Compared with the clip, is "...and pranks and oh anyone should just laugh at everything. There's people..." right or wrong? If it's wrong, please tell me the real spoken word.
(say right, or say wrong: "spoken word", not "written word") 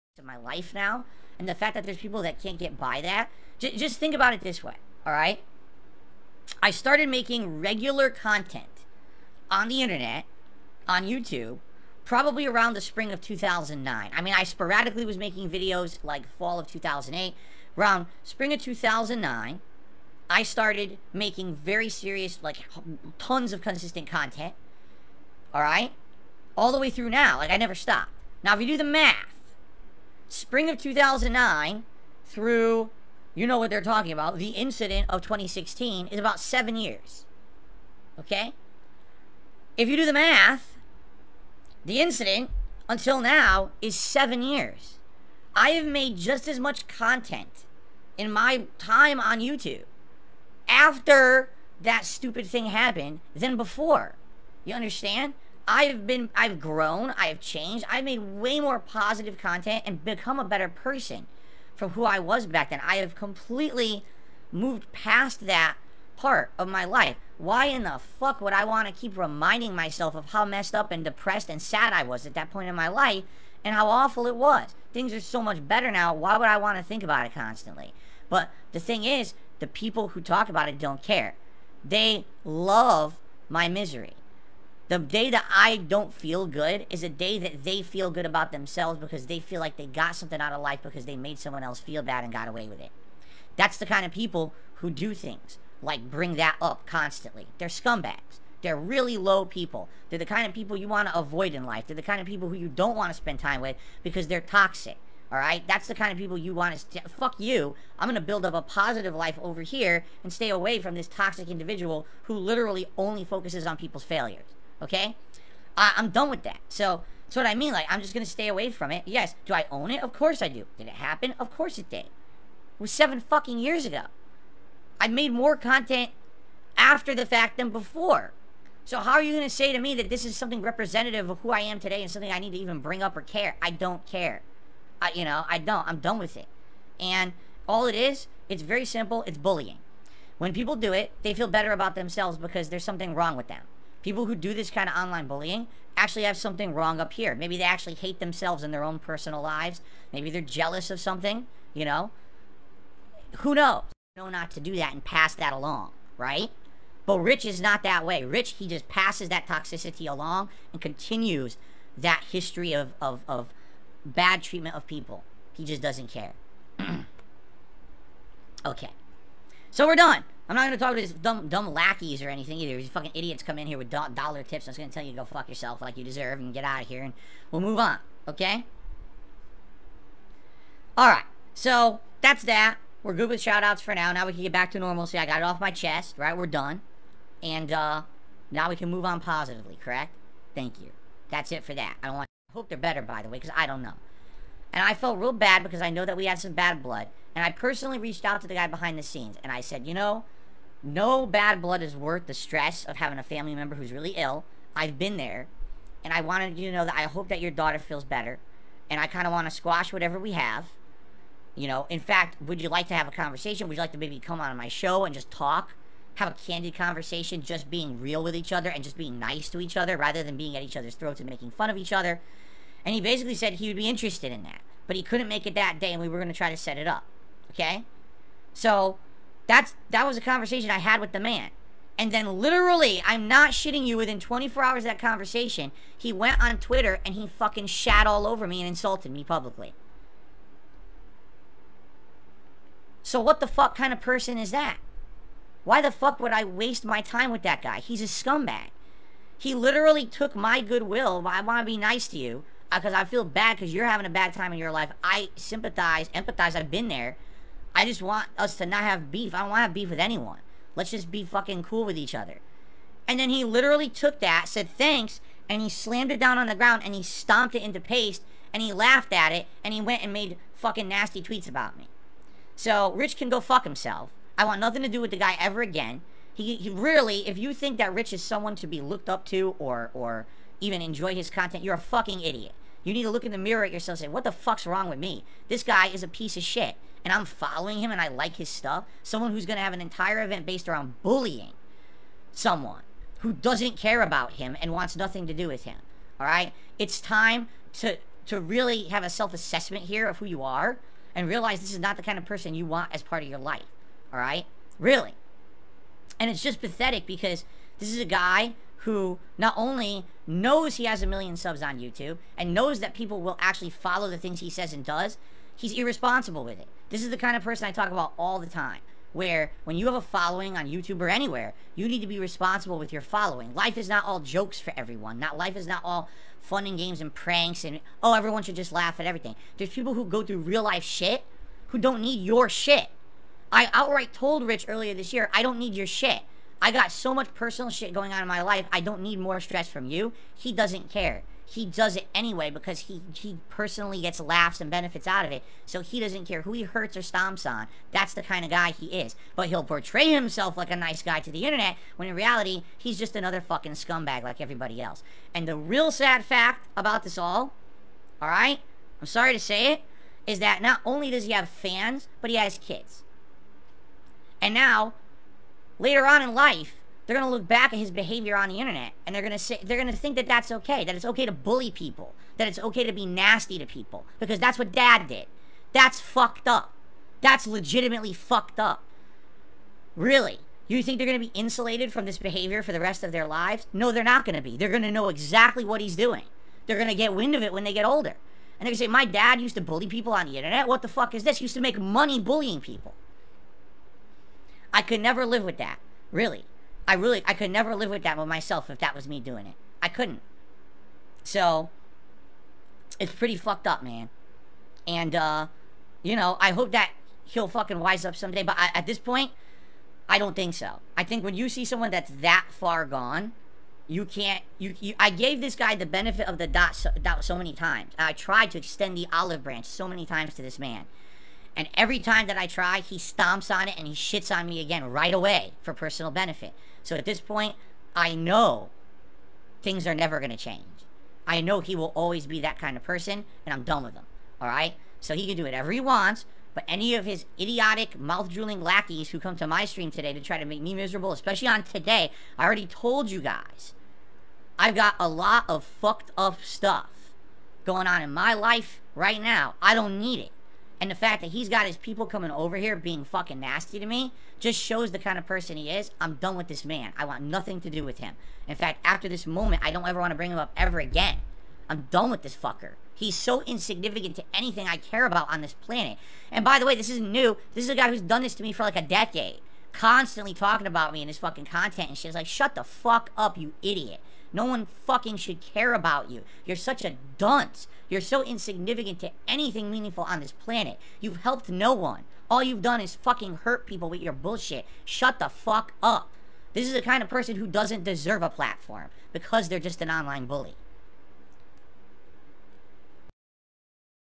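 wrong: "everyone", not "anyone".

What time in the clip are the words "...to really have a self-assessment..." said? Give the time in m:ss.
4:58.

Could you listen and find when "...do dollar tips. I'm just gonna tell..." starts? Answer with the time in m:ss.
2:53.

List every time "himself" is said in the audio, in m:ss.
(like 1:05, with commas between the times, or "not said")
4:33, 5:50.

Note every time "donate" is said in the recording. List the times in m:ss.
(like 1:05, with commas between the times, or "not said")
not said.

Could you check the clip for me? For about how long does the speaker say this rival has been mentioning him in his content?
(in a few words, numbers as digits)
a decade.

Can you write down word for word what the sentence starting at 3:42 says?
And he basically said he would be interested in that.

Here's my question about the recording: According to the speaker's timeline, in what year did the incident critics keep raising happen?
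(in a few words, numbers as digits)
2016.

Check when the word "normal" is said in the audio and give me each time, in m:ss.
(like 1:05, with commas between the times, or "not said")
3:04.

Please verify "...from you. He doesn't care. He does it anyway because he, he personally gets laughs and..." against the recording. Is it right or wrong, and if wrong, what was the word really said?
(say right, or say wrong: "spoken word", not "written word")
right.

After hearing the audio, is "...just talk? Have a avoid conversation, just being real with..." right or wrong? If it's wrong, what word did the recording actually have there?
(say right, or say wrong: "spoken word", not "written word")
wrong: "candid", not "avoid".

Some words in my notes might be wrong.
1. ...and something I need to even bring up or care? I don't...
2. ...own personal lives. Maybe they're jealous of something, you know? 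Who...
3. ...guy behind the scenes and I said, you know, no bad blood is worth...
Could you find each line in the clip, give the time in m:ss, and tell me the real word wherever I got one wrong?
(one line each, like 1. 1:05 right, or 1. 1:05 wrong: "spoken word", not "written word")
1. 2:12 right
2. 2:28 right
3. 3:18 right.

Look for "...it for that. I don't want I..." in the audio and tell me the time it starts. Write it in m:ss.
3:11.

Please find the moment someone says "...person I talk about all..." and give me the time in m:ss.
5:17.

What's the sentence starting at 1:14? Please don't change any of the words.
Things are so much better now.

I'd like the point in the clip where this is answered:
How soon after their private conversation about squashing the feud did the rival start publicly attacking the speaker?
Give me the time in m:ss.
3:53.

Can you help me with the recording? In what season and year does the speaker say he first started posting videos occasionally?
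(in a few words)
fall of 2008.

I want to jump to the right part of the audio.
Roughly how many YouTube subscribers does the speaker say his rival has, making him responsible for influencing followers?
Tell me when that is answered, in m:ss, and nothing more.
5:11.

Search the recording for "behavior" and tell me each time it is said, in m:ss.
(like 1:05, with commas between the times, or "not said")
6:07, 6:22.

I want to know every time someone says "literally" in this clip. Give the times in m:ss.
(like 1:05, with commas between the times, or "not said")
1:52, 3:52, 4:09, 4:23.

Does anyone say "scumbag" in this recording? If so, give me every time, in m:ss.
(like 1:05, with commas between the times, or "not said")
1:37, 4:08, 5:53.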